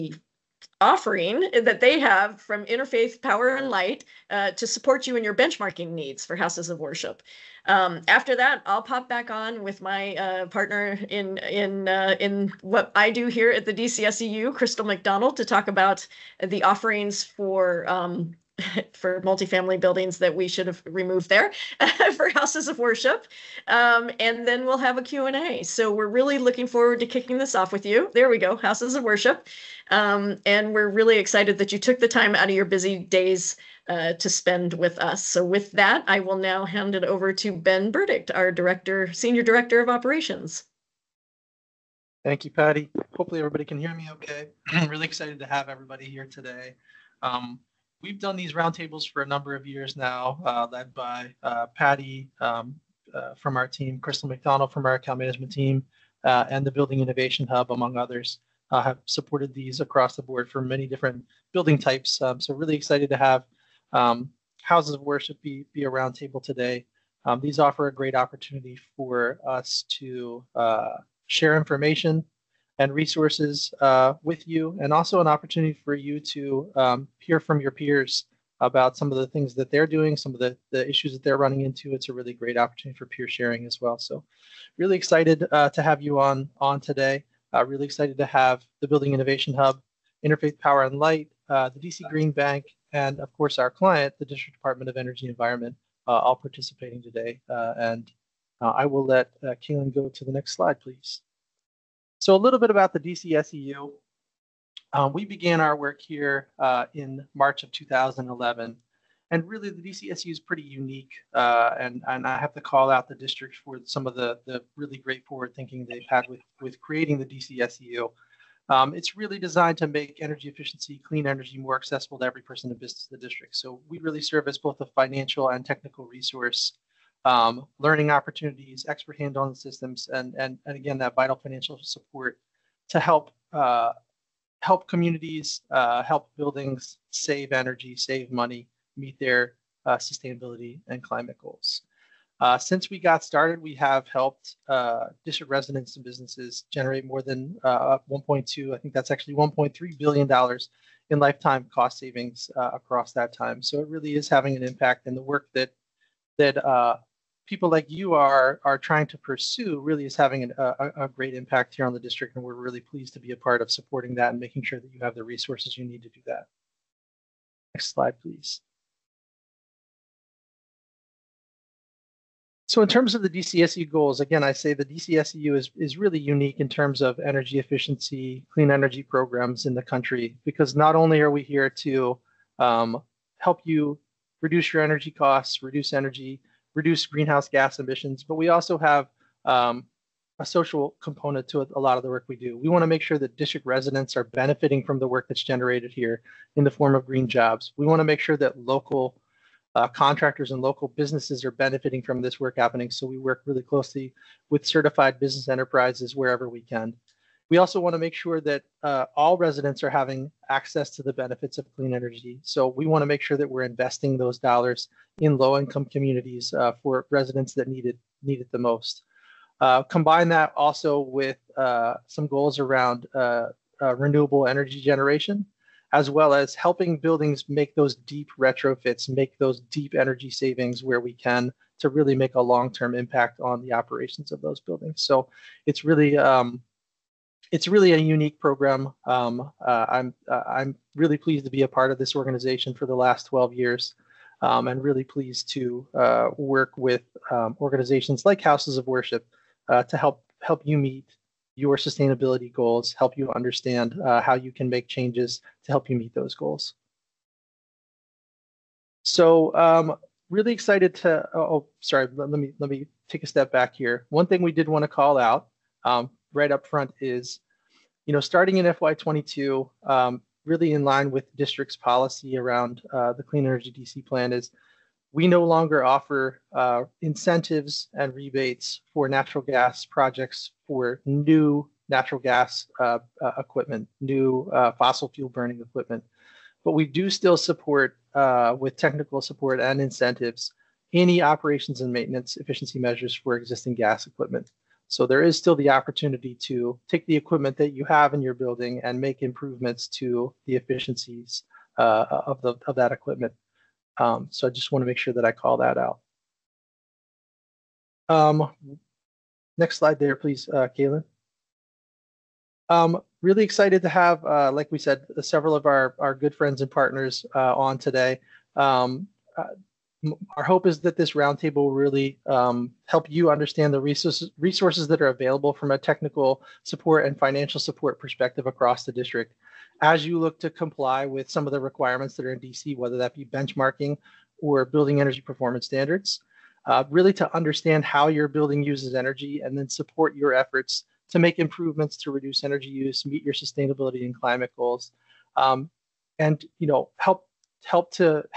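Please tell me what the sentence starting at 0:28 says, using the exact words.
There we go, houses of worship.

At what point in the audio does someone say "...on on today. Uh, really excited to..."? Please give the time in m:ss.
1:26.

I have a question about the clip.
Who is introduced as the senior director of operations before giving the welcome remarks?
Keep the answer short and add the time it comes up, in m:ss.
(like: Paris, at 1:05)
Ben Burdick, at 0:37.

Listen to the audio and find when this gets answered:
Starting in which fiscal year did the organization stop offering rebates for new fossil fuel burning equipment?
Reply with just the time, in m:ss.
4:28.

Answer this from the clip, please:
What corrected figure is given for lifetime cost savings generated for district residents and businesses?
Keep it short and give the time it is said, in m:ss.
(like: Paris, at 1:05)
$1.3 billion, at 2:29.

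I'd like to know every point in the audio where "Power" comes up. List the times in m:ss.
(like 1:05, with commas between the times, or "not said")
0:03, 1:30.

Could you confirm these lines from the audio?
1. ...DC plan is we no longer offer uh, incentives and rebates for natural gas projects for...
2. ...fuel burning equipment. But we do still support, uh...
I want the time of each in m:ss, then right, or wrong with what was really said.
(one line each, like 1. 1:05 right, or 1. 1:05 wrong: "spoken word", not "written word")
1. 4:33 right
2. 4:45 right.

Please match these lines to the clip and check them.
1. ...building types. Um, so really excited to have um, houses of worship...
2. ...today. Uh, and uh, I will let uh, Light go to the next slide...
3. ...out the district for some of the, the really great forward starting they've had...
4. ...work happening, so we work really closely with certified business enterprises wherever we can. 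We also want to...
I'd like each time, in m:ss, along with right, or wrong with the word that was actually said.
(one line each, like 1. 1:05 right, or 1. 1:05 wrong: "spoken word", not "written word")
1. 1:01 right
2. 1:37 wrong: "Kaylin", not "Light"
3. 1:52 wrong: "thinking", not "starting"
4. 3:22 right.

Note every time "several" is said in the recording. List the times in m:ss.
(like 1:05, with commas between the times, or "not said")
5:15.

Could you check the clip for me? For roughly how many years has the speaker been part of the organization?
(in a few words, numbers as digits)
12 years.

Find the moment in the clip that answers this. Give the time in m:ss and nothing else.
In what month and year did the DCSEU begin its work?
1:47.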